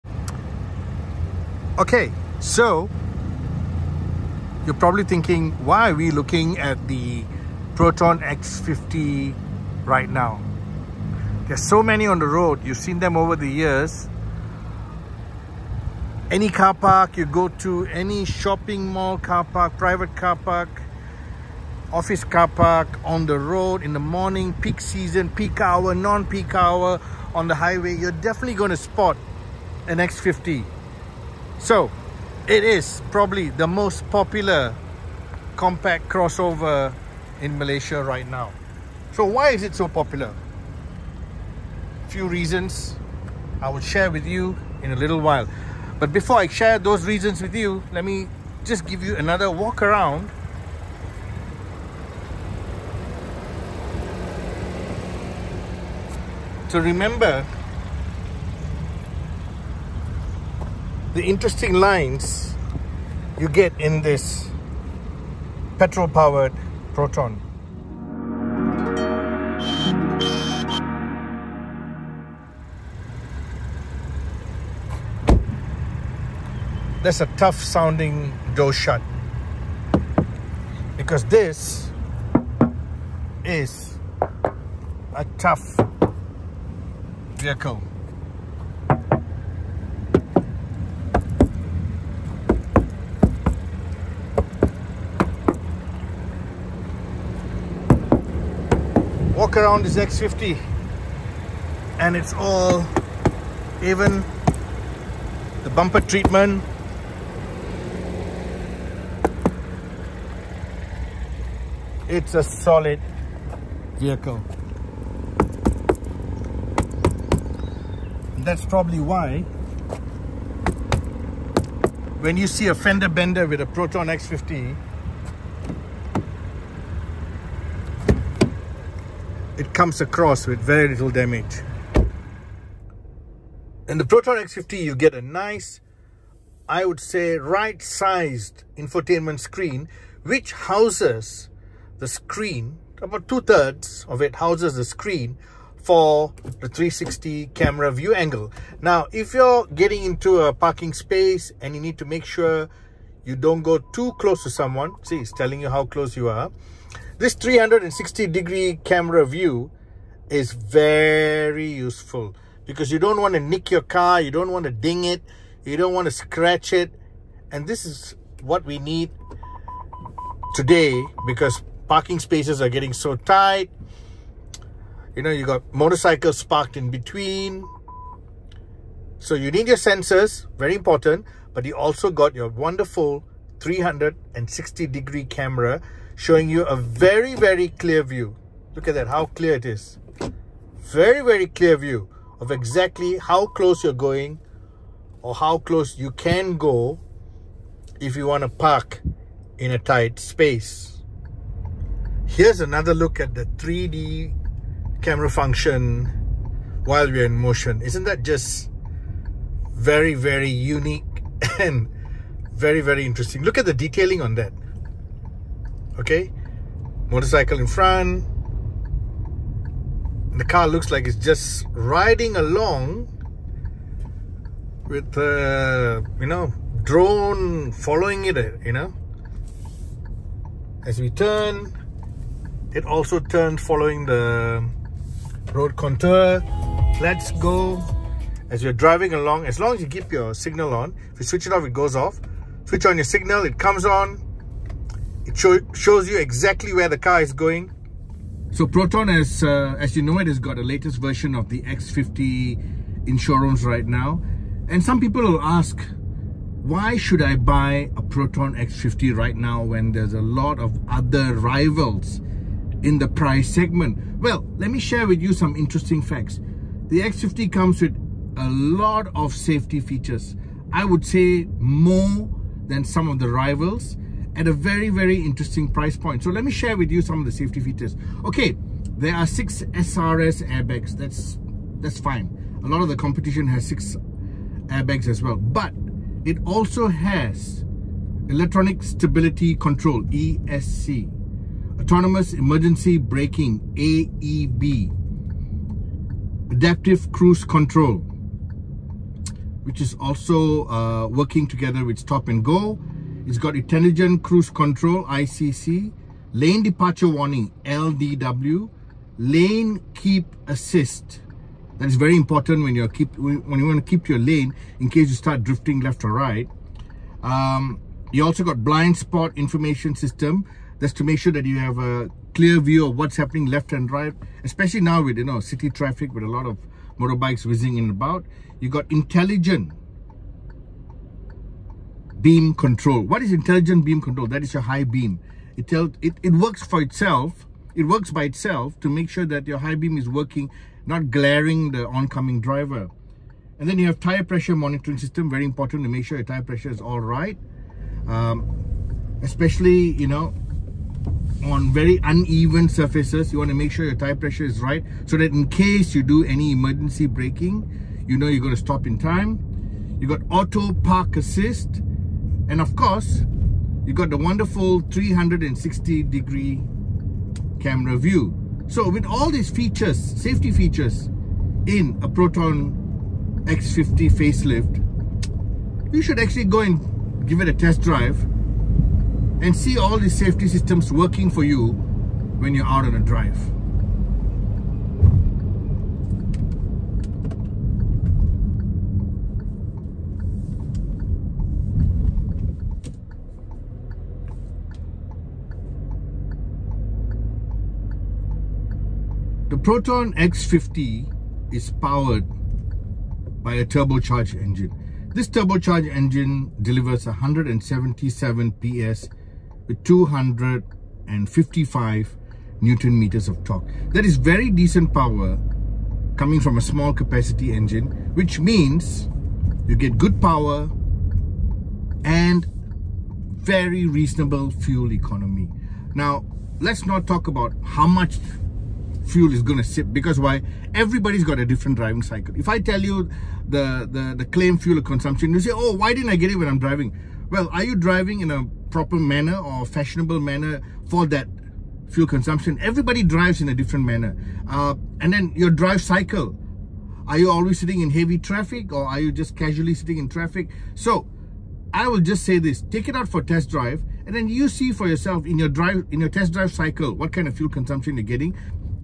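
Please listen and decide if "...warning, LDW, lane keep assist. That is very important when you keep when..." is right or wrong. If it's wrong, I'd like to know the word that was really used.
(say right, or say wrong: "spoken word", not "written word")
right.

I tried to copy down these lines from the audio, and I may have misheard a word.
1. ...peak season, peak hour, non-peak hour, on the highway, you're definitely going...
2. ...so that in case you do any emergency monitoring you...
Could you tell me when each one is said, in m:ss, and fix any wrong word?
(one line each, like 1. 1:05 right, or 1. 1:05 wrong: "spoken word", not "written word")
1. 0:24 right
2. 5:55 wrong: "braking", not "monitoring".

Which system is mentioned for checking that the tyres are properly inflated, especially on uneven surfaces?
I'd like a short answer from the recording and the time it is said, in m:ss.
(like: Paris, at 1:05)
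Tire pressure monitoring system, at 5:43.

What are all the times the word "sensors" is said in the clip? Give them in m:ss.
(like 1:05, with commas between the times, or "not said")
2:59.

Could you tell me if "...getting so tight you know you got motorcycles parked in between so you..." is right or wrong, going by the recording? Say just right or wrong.
right.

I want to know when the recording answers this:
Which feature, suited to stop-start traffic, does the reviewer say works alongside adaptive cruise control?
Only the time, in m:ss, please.
5:01.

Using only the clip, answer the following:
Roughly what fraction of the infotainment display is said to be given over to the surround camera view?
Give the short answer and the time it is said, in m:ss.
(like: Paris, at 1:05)
Two-thirds, at 2:23.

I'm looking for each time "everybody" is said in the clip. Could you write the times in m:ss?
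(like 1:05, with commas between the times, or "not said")
7:10, 7:22.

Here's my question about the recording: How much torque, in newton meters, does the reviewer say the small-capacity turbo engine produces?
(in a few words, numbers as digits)
255 Nm.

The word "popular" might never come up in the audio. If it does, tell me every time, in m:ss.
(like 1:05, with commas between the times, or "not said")
0:34, 0:39.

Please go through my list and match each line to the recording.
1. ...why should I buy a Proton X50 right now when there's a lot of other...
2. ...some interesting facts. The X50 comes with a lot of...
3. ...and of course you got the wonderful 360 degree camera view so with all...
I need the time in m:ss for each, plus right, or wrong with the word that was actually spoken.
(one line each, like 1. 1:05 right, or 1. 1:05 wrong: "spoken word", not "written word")
1. 4:16 right
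2. 4:25 right
3. 6:02 right.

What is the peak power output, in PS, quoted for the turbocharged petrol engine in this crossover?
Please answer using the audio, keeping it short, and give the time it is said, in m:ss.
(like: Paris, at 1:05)
177 PS, at 6:47.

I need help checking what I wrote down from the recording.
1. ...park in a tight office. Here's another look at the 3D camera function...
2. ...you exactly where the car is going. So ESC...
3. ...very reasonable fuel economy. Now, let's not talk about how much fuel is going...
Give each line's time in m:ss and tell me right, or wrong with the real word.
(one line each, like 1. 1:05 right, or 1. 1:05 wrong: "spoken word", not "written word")
1. 3:18 wrong: "space", not "office"
2. 4:06 wrong: "Proton", not "ESC"
3. 7:03 right.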